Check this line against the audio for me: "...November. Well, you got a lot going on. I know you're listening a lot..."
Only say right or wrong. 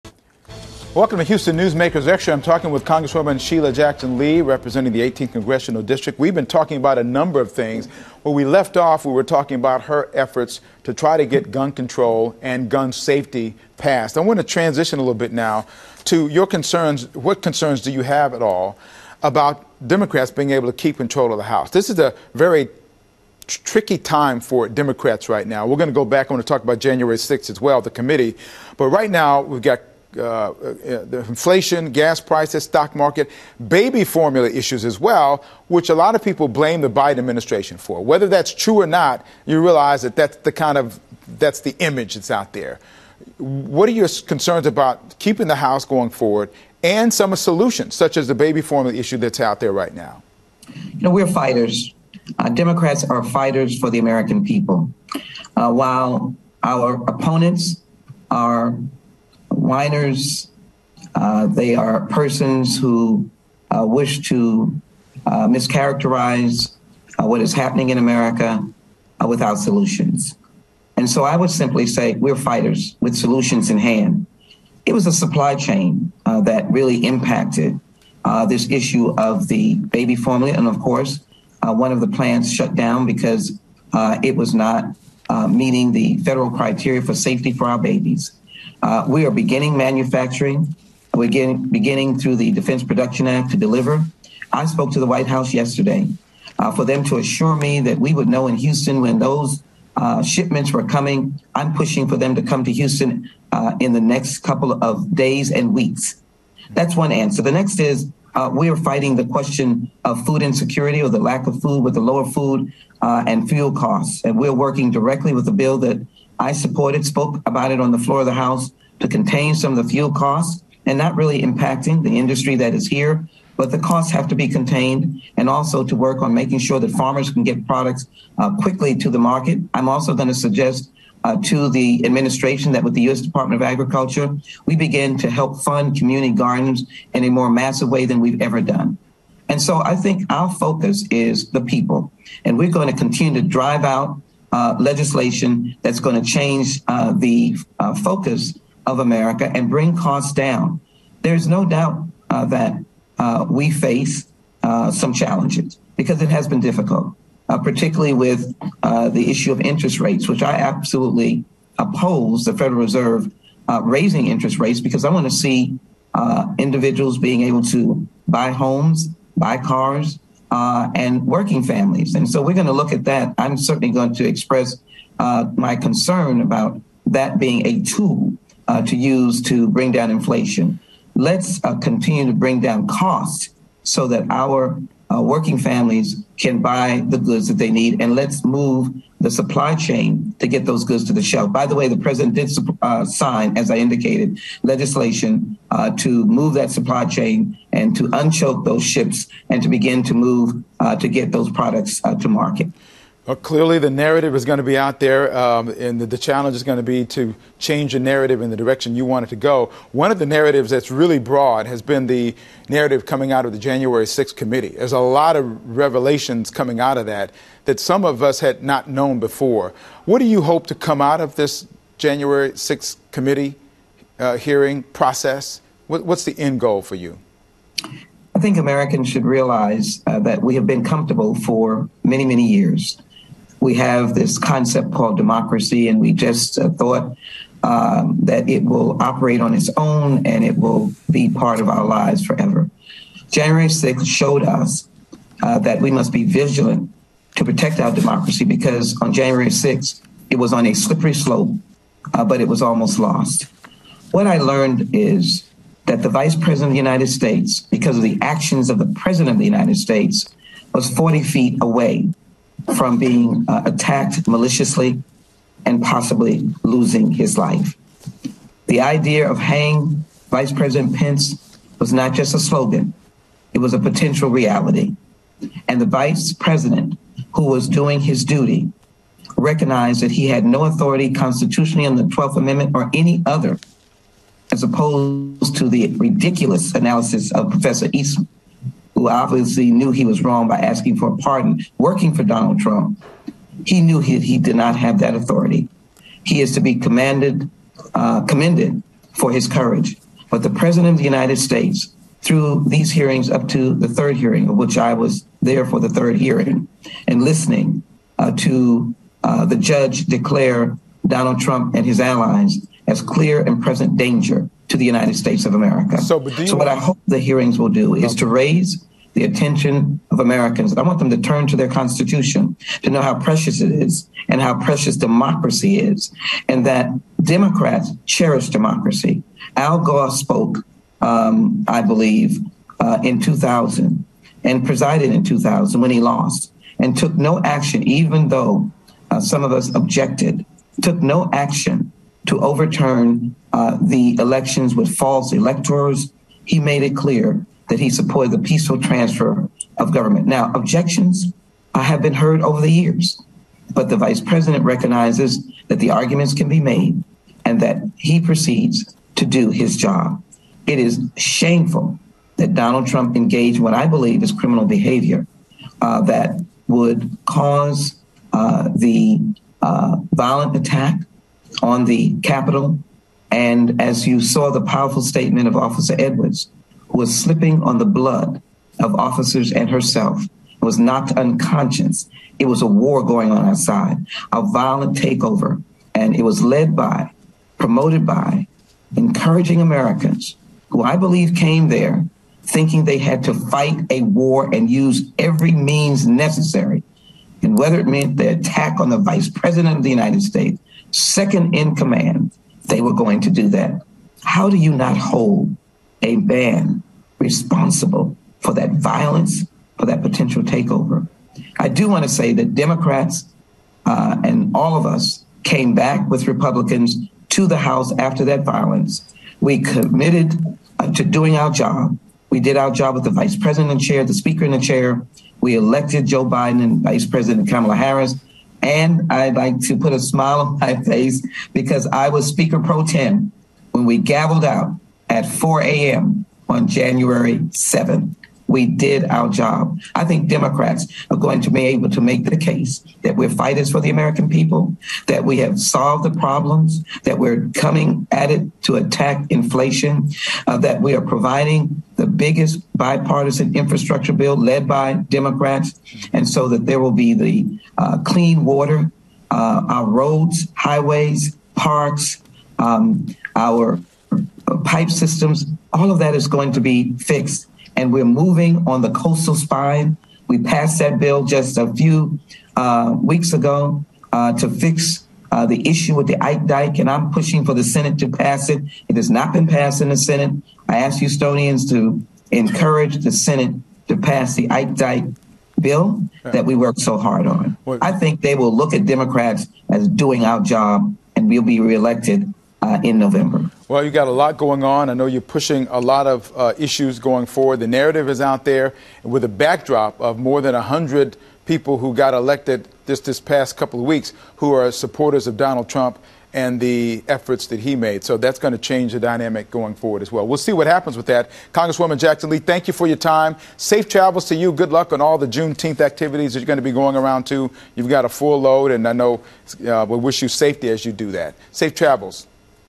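wrong.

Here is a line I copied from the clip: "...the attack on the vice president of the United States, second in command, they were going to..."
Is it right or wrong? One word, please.
right.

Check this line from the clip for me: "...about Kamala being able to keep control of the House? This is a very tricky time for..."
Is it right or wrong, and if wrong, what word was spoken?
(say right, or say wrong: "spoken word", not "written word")
wrong: "Democrats", not "Kamala".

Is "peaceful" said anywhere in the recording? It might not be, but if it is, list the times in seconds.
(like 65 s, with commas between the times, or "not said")
348 s.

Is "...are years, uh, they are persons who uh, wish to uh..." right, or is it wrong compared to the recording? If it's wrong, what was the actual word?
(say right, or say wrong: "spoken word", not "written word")
wrong: "minors", not "years".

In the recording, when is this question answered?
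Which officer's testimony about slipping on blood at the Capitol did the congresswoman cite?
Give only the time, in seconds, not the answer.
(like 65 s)
375 s.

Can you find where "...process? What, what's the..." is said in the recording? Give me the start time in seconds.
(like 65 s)
224 s.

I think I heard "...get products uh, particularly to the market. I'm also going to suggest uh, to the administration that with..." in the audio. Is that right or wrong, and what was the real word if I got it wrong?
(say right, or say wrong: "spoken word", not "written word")
wrong: "quickly", not "particularly".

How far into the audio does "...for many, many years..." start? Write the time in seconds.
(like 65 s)
231 s.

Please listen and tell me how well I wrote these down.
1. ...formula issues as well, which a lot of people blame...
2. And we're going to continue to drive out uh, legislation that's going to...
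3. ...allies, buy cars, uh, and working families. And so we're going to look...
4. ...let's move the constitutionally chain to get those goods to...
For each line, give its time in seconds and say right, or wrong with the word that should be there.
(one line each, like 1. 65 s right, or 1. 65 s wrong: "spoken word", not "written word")
1. 34 s right
2. 142 s right
3. 168 s wrong: "homes", not "allies"
4. 188 s wrong: "supply", not "constitutionally".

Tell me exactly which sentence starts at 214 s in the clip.
There's a lot of revelations coming out of that that some of us had not known before.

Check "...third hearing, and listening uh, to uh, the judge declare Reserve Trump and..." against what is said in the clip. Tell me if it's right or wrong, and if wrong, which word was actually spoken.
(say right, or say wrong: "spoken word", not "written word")
wrong: "Donald", not "Reserve".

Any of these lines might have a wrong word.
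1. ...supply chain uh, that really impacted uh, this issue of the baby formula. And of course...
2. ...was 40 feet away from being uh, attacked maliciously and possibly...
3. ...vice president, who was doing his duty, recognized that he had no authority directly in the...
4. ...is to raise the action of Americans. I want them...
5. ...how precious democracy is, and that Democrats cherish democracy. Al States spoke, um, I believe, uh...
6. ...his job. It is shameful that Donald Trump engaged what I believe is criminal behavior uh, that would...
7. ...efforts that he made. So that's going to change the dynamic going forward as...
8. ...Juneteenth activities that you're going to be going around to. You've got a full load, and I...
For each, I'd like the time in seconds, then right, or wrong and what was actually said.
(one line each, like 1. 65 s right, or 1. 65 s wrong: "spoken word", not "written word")
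1. 75 s right
2. 260 s right
3. 275 s wrong: "constitutionally", not "directly"
4. 317 s wrong: "attention", not "action"
5. 324 s wrong: "Gore", not "States"
6. 359 s right
7. 507 s right
8. 515 s right.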